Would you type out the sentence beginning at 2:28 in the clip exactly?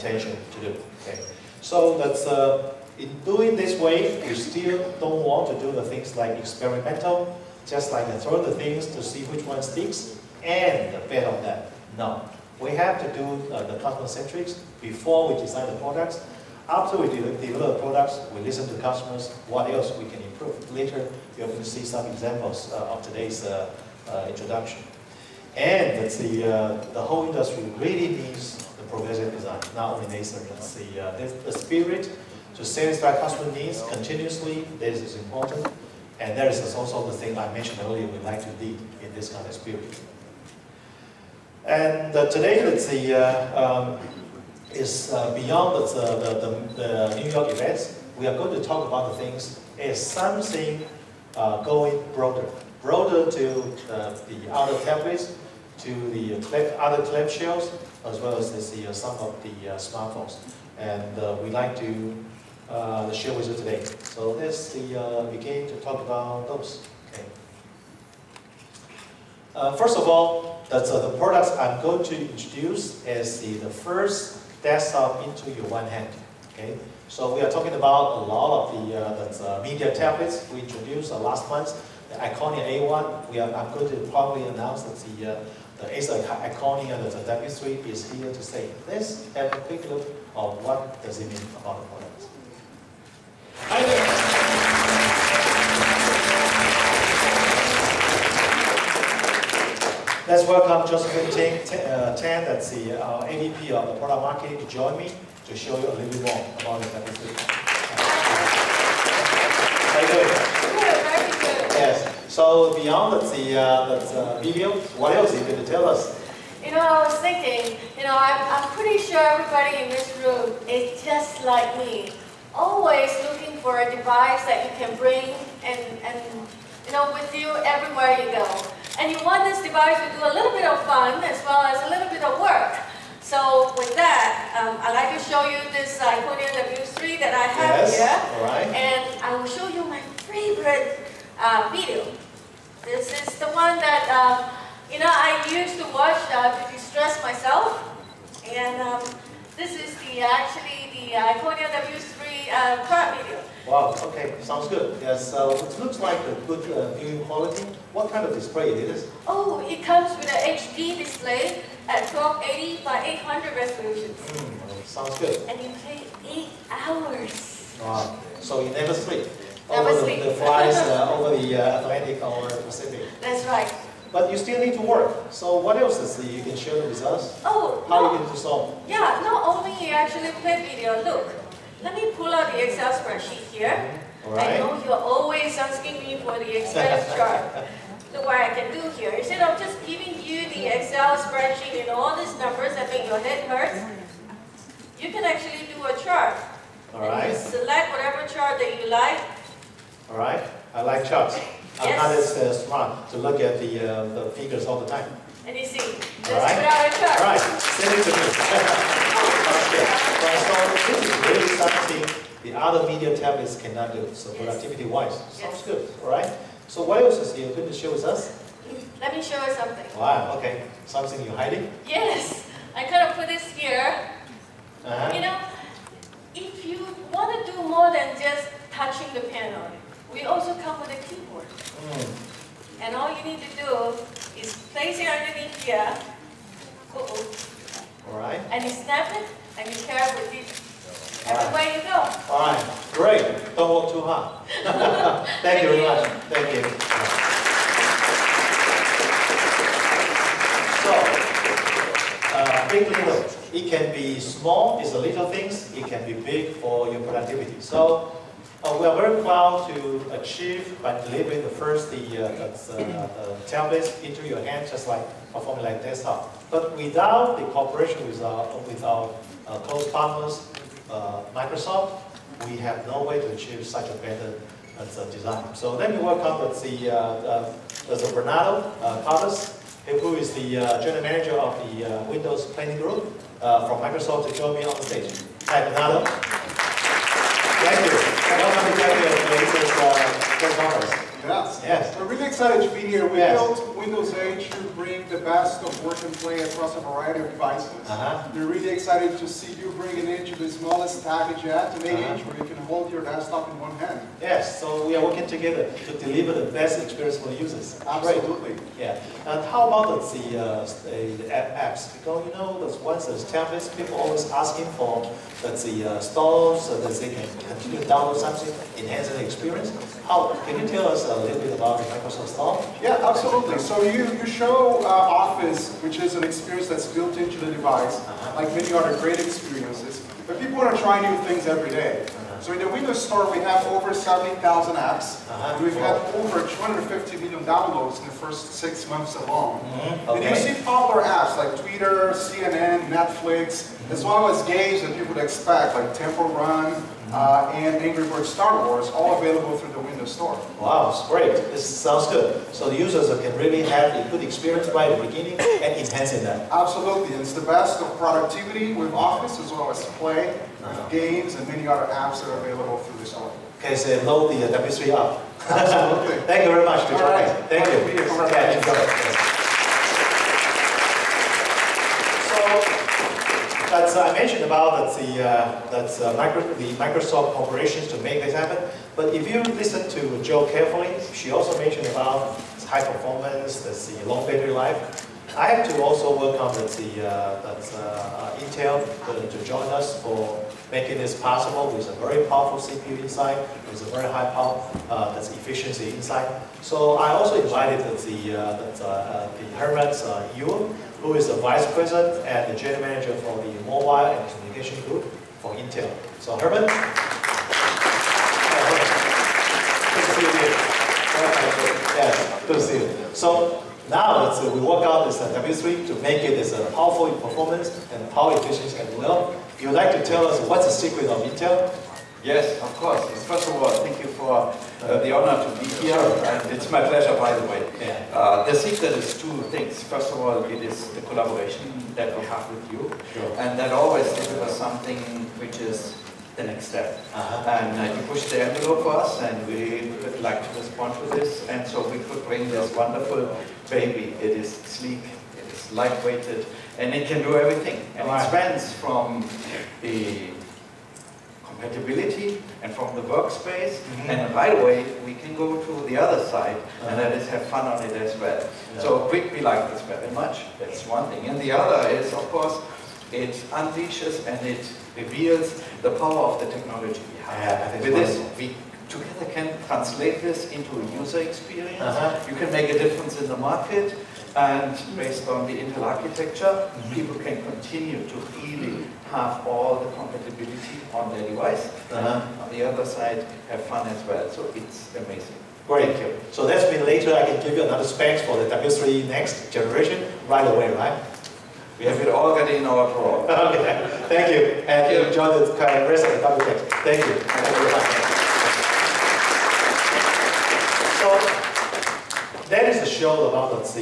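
And um, this is the actually the Iconia W3 uh, uh crop video.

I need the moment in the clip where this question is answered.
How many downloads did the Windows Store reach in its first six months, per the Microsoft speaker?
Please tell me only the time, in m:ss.
5:36.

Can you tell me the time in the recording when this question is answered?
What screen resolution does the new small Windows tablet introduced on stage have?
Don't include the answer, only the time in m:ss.
2:42.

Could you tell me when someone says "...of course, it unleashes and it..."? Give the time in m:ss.
7:42.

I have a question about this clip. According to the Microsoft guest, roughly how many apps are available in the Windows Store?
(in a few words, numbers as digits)
70,000.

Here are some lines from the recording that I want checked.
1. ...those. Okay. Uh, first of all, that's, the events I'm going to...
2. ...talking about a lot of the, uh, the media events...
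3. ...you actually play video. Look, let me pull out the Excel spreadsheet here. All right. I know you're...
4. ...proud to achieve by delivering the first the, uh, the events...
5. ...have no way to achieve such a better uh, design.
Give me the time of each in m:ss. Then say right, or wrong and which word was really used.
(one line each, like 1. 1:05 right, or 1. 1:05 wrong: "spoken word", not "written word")
1. 1:06 wrong: "products", not "events"
2. 1:17 wrong: "tablets", not "events"
3. 2:59 right
4. 4:19 wrong: "tablets", not "events"
5. 4:32 right.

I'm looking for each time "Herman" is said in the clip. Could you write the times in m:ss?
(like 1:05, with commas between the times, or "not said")
6:39, 6:46.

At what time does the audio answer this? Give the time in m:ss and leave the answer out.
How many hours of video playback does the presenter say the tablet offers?
2:46.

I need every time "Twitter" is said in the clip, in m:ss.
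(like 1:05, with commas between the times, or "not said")
5:41.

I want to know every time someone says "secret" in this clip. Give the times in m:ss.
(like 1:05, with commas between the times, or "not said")
7:00, 7:08.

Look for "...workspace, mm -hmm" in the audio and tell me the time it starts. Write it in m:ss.
7:33.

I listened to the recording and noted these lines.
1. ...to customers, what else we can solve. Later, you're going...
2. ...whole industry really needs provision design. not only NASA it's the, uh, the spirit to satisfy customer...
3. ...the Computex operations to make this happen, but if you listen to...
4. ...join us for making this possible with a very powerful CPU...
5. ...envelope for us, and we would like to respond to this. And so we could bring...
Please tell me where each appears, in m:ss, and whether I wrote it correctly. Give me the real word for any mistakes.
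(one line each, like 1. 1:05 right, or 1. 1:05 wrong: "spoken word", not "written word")
1. 0:18 wrong: "improve", not "solve"
2. 0:27 right
3. 6:16 wrong: "Microsoft", not "Computex"
4. 6:29 right
5. 7:18 right.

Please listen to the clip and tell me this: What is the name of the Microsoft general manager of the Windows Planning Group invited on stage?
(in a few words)
Bernardo Caldas.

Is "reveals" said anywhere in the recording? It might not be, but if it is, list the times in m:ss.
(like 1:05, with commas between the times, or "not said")
7:44.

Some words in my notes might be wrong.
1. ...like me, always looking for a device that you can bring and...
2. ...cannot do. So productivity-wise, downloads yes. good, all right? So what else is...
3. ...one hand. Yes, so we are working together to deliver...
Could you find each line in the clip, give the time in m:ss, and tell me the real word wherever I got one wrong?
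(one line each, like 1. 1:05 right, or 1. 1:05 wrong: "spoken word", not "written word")
1. 2:01 right
2. 3:33 wrong: "sounds", not "downloads"
3. 5:03 right.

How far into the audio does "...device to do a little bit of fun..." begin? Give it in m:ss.
2:09.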